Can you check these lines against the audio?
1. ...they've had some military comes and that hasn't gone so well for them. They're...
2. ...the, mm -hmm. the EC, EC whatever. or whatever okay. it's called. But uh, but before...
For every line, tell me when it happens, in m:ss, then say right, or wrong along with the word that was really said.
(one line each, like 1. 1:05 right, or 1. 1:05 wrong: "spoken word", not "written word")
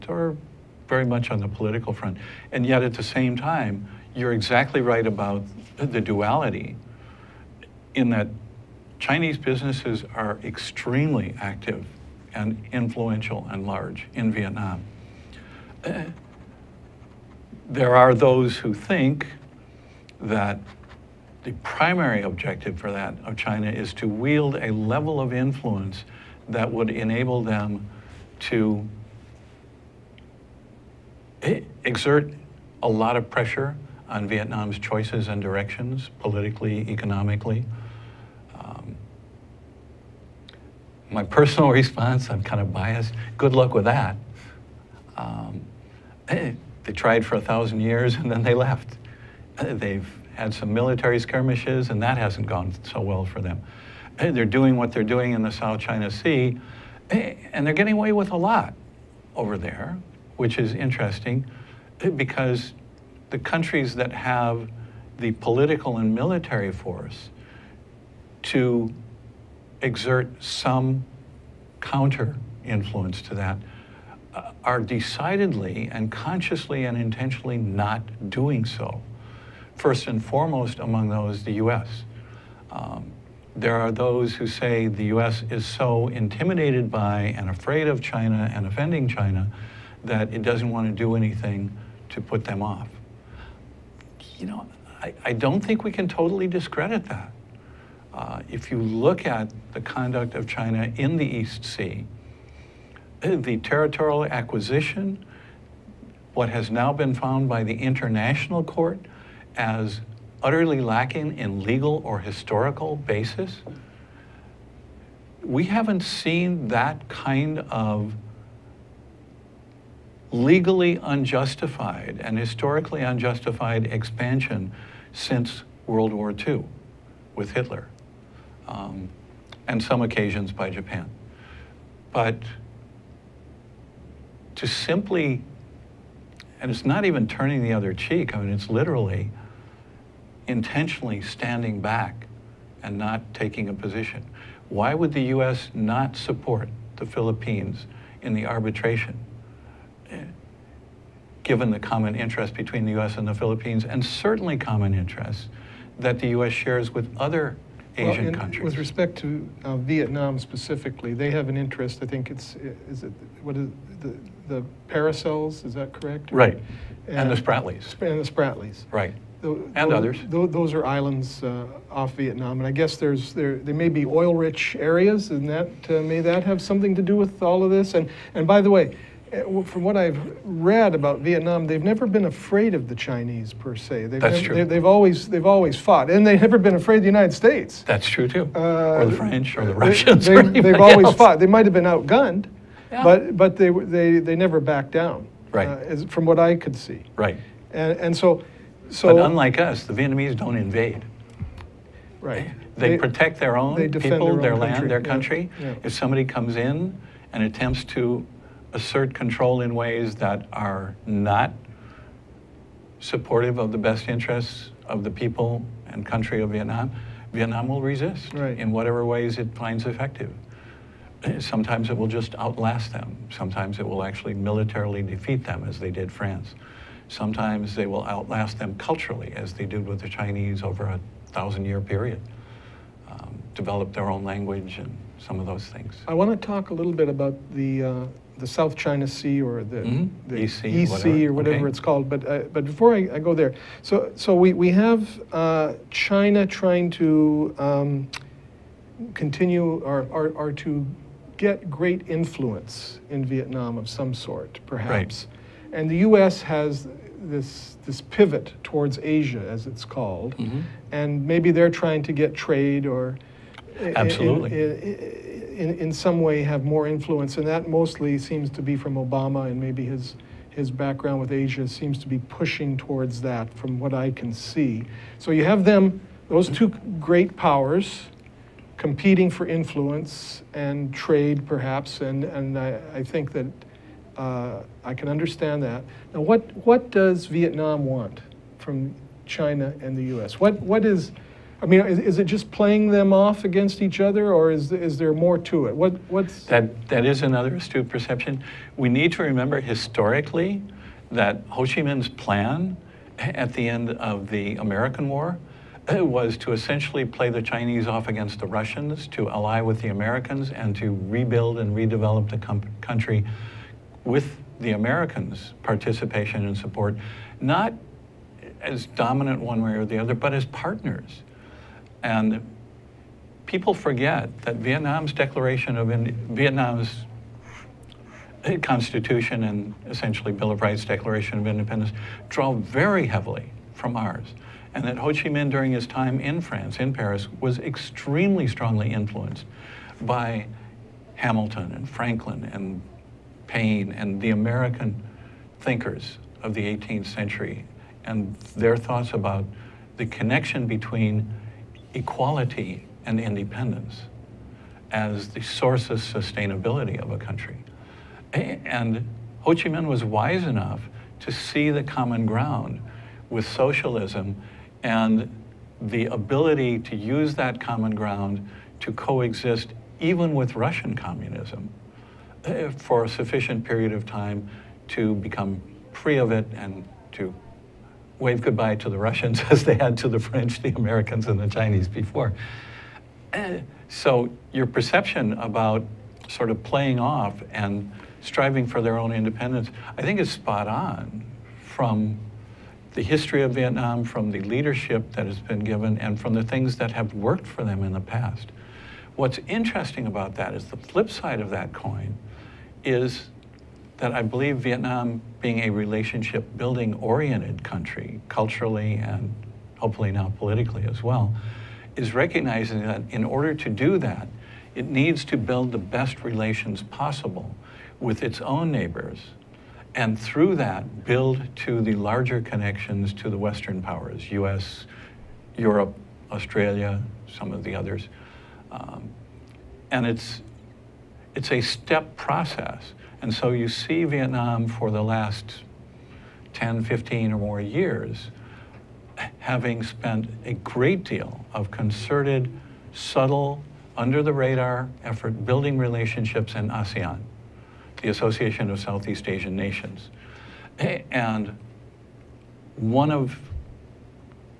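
1. 0:49 wrong: "skirmishes", not "comes"
2. 3:59 right.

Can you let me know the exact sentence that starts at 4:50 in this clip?
What, what is, I mean, is, is, it just playing them off against each other, or is, is there more to it?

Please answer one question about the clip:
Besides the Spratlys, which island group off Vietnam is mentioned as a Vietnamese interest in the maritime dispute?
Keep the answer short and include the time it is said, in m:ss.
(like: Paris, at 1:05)
Paracels, at 2:44.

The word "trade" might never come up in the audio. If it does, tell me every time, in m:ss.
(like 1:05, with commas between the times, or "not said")
4:22, 4:40.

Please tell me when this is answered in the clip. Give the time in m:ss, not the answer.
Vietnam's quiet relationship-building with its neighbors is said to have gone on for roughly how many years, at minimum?
7:16.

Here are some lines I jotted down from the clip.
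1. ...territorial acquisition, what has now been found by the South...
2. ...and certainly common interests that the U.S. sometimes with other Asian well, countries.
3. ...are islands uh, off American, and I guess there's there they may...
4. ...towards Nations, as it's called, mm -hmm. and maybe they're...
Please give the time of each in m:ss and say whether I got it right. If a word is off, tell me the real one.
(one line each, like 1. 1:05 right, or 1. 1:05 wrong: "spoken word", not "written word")
1. 1:43 wrong: "International", not "South"
2. 2:33 wrong: "shares", not "sometimes"
3. 2:50 wrong: "Vietnam", not "American"
4. 4:18 wrong: "Asia", not "Nations".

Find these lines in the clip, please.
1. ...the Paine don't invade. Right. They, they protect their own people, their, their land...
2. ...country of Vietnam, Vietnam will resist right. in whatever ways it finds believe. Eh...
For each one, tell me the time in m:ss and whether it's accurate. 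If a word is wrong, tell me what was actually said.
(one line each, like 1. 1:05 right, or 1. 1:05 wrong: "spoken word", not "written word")
1. 3:19 wrong: "Vietnamese", not "Paine"
2. 3:36 wrong: "effective", not "believe".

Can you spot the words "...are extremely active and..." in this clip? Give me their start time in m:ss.
0:10.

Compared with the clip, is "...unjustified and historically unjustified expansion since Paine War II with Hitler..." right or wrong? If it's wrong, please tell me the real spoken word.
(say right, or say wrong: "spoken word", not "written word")
wrong: "World", not "Paine".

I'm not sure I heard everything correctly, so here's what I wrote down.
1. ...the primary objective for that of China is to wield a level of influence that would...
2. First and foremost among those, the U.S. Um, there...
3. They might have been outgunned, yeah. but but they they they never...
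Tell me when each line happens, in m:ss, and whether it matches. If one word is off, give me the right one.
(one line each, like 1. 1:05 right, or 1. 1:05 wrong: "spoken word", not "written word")
1. 0:21 right
2. 1:19 right
3. 3:11 right.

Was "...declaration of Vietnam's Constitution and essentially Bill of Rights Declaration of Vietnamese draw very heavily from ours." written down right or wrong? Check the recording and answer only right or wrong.
wrong.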